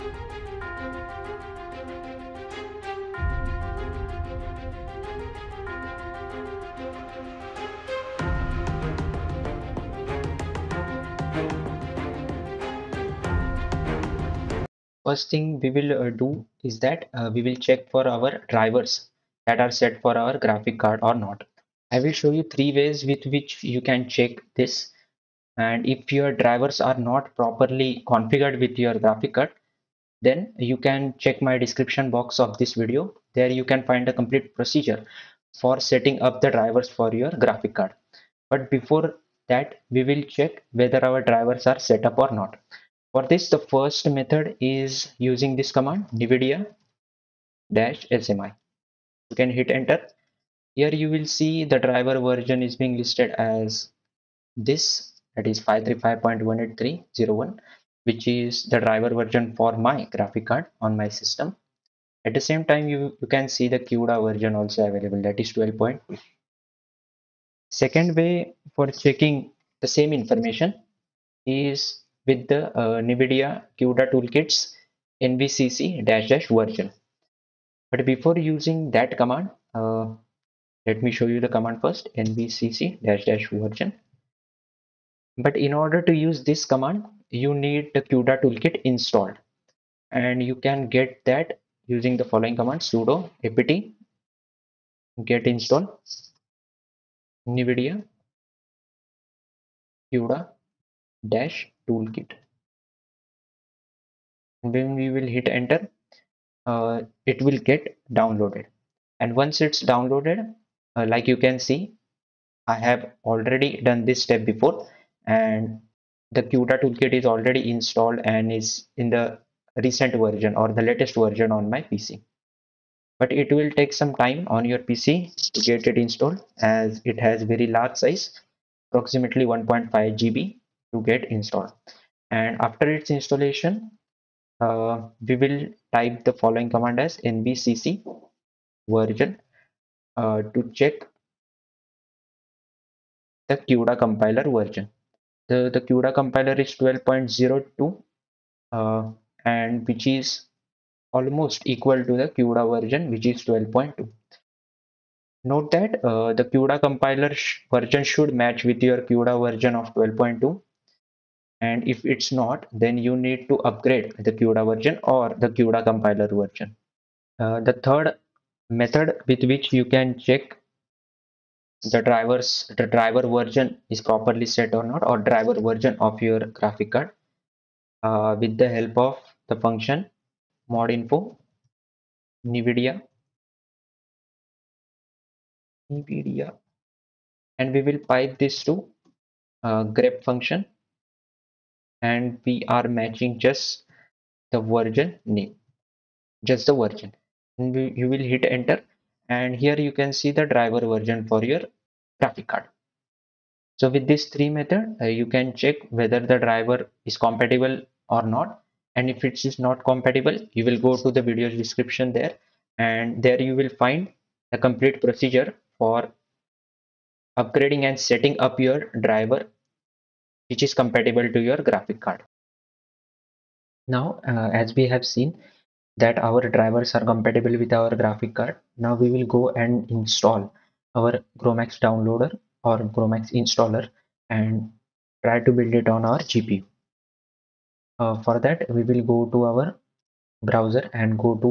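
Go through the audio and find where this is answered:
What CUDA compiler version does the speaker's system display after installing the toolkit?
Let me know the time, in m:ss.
2:26.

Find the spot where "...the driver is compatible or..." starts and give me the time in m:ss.
3:26.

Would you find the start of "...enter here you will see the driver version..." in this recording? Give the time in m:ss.
0:49.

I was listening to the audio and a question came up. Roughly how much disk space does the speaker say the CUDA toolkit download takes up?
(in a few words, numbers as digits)
1.5 GB.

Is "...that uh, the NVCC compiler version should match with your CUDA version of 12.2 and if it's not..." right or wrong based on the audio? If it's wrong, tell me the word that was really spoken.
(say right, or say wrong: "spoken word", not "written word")
wrong: "CUDA", not "NVCC".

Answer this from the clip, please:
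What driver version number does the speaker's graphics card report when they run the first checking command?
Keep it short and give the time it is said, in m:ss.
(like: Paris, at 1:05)
535.18301, at 0:55.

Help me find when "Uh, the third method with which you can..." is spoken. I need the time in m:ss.
2:47.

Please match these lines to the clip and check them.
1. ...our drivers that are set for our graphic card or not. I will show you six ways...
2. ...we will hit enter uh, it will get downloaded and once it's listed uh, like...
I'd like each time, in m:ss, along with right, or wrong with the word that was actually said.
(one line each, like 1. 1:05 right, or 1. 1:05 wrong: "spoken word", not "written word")
1. 0:18 wrong: "three", not "six"
2. 1:45 wrong: "downloaded", not "listed".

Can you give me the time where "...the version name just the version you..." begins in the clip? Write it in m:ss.
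3:14.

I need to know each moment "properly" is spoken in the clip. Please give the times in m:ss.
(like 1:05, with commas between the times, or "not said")
0:27, 2:54.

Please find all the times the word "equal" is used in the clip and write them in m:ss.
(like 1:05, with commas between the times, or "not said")
2:31.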